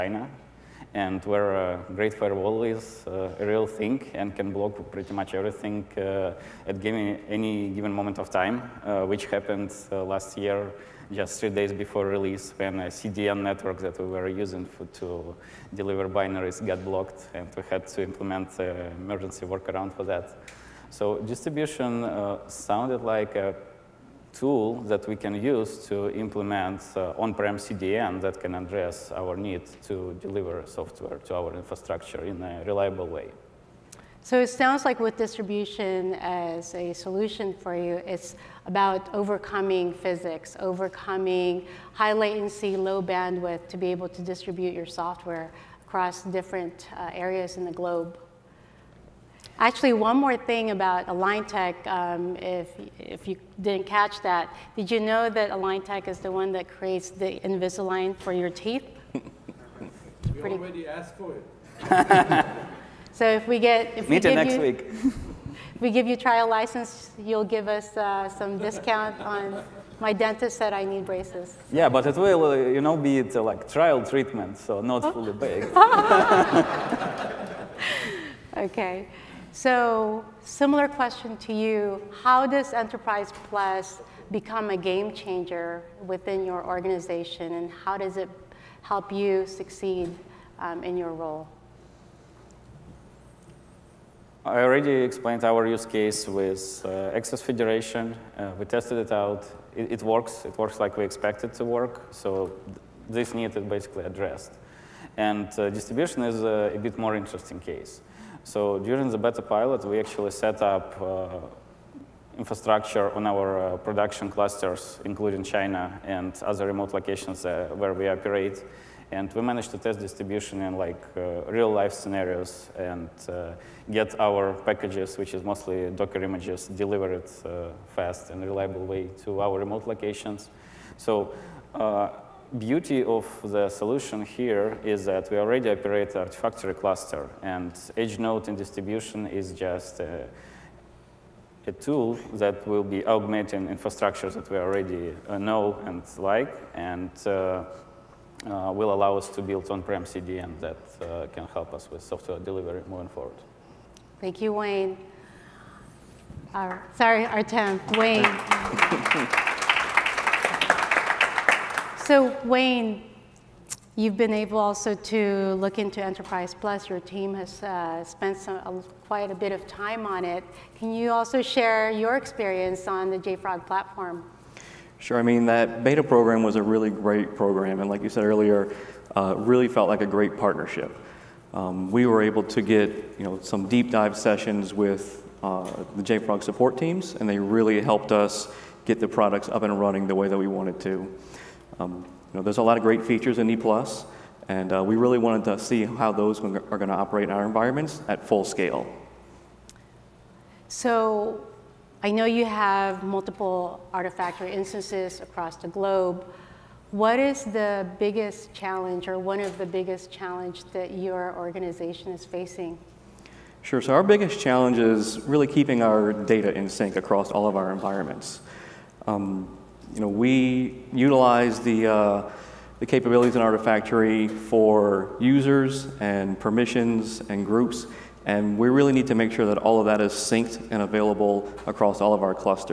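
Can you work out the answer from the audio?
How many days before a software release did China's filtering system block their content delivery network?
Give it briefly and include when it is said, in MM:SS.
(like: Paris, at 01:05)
3, at 00:11.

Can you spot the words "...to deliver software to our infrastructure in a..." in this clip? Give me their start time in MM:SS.
00:29.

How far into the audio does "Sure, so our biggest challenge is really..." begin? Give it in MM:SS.
03:33.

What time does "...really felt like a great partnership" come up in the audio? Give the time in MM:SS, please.
02:59.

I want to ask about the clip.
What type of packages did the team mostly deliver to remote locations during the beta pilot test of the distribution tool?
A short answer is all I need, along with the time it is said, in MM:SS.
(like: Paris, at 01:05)
Docker images, at 02:05.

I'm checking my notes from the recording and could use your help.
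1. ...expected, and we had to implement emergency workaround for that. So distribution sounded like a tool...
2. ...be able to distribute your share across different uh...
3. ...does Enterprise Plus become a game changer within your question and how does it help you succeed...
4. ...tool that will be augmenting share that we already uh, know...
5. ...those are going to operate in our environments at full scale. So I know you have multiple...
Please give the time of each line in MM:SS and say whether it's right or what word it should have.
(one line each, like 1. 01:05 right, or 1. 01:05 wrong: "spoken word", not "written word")
1. 00:16 wrong: "blocked", not "expected"
2. 00:43 wrong: "software", not "share"
3. 01:22 wrong: "organization", not "question"
4. 02:21 wrong: "infrastructure", not "share"
5. 03:16 right.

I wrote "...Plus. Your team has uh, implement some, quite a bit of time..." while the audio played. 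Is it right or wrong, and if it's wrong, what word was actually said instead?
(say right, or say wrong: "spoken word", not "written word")
wrong: "spent", not "implement".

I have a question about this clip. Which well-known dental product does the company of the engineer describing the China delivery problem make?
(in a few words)
Invisalign.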